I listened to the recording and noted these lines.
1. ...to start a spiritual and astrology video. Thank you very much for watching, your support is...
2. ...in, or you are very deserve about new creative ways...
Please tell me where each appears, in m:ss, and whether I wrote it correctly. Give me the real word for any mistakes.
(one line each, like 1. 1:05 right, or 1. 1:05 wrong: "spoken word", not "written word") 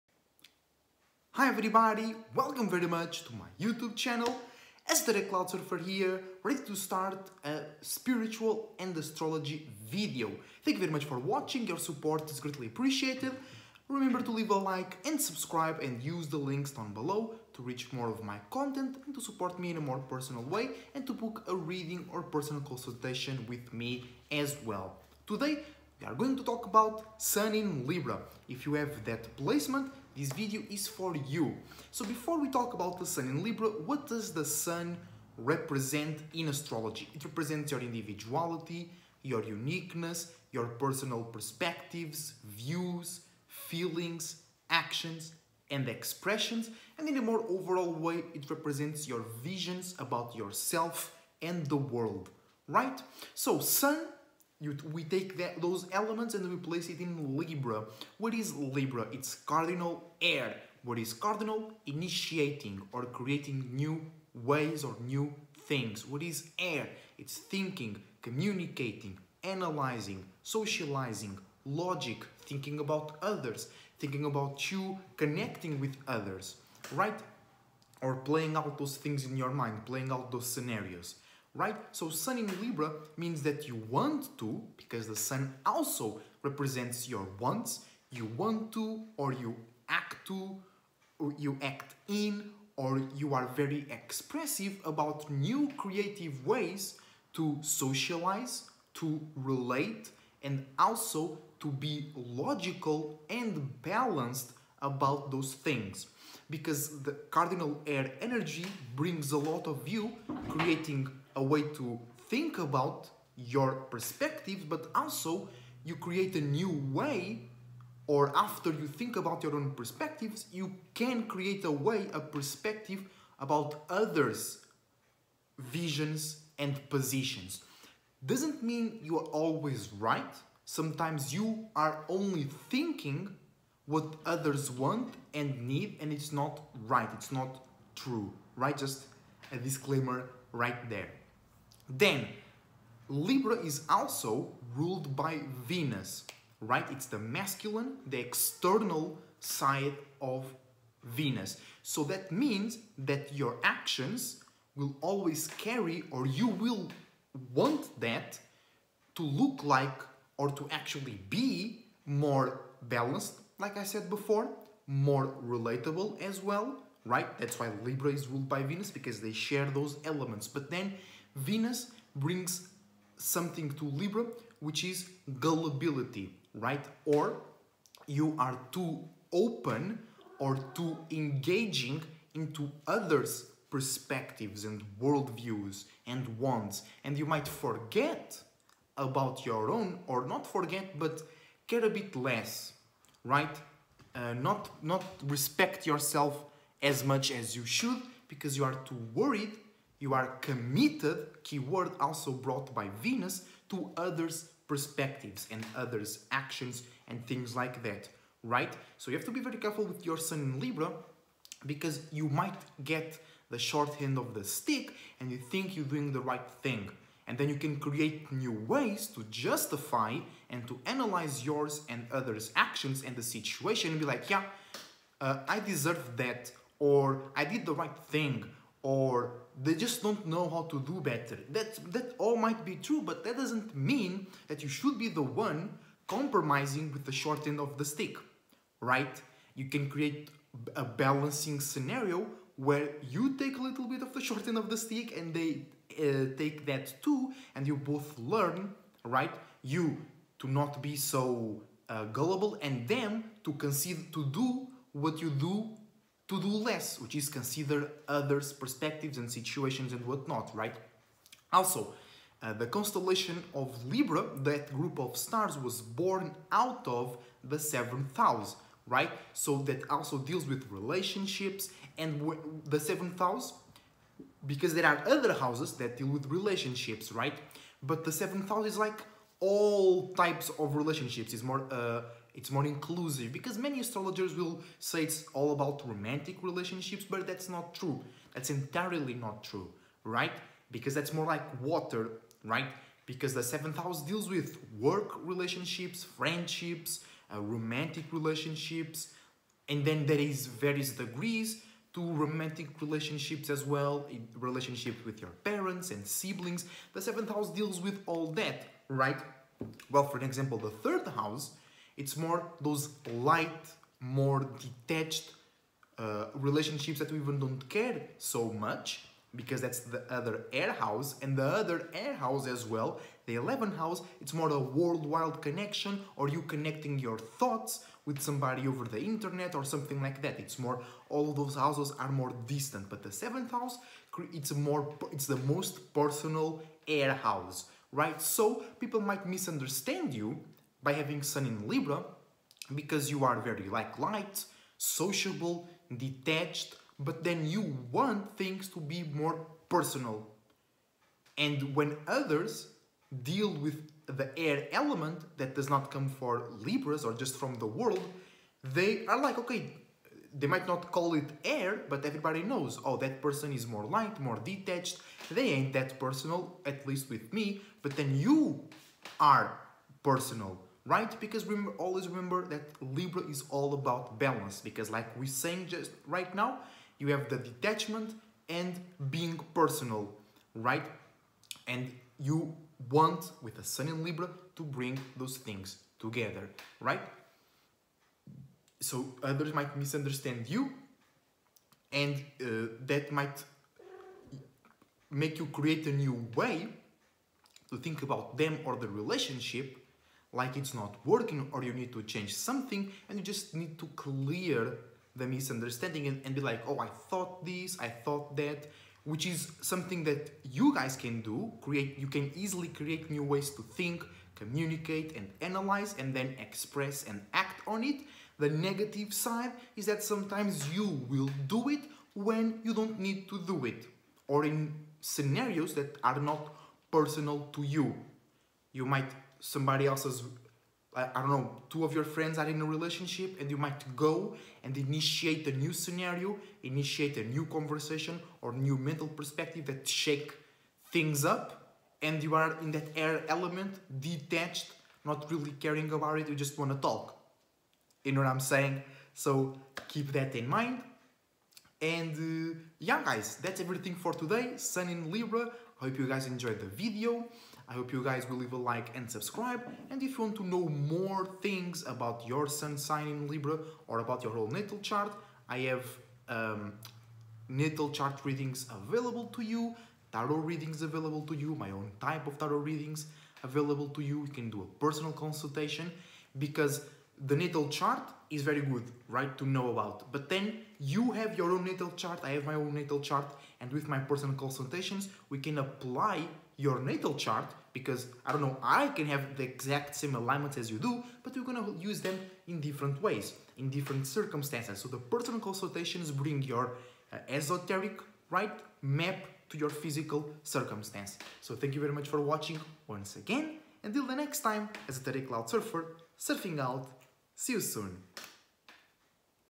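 1. 0:06 right
2. 1:32 wrong: "expressive", not "deserve".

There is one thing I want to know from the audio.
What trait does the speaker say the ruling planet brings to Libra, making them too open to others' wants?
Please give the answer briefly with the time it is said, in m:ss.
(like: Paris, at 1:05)
gullibility, at 2:55.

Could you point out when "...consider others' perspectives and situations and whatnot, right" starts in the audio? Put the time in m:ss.
4:17.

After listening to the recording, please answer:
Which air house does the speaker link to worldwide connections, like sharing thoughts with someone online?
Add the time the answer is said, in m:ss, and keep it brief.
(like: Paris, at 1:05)
11th house, at 5:23.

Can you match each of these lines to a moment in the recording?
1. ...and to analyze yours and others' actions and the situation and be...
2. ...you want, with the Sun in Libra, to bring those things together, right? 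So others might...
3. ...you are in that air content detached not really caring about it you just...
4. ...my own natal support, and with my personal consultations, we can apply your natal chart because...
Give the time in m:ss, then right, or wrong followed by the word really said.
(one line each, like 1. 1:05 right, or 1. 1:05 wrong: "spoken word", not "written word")
1. 3:40 right
2. 6:22 right
3. 7:22 wrong: "element", not "content"
4. 8:02 wrong: "chart", not "support".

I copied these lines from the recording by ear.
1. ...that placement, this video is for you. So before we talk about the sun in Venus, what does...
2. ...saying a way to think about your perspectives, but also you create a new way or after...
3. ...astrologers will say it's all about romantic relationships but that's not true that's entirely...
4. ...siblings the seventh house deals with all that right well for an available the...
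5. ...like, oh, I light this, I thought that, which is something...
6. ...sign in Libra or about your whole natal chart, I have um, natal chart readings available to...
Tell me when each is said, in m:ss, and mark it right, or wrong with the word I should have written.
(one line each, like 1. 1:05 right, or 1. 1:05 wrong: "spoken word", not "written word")
1. 0:29 wrong: "Libra", not "Venus"
2. 1:50 wrong: "creating", not "saying"
3. 4:43 right
4. 5:06 wrong: "example", not "available"
5. 6:46 wrong: "thought", not "light"
6. 7:42 right.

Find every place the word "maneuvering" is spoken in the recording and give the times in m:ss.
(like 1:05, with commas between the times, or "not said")
not said.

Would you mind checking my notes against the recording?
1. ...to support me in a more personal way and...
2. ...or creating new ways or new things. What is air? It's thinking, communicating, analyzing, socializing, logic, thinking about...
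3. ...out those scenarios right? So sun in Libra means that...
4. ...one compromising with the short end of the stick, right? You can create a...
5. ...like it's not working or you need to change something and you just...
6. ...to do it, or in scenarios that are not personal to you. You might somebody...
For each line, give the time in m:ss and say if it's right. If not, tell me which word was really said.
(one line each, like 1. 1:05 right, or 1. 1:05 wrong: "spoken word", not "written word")
1. 0:19 right
2. 1:02 right
3. 1:20 right
4. 3:55 right
5. 6:40 right
6. 7:03 right.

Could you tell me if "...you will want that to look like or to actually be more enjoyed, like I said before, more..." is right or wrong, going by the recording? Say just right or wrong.
wrong.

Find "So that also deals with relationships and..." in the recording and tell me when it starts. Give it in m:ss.
4:29.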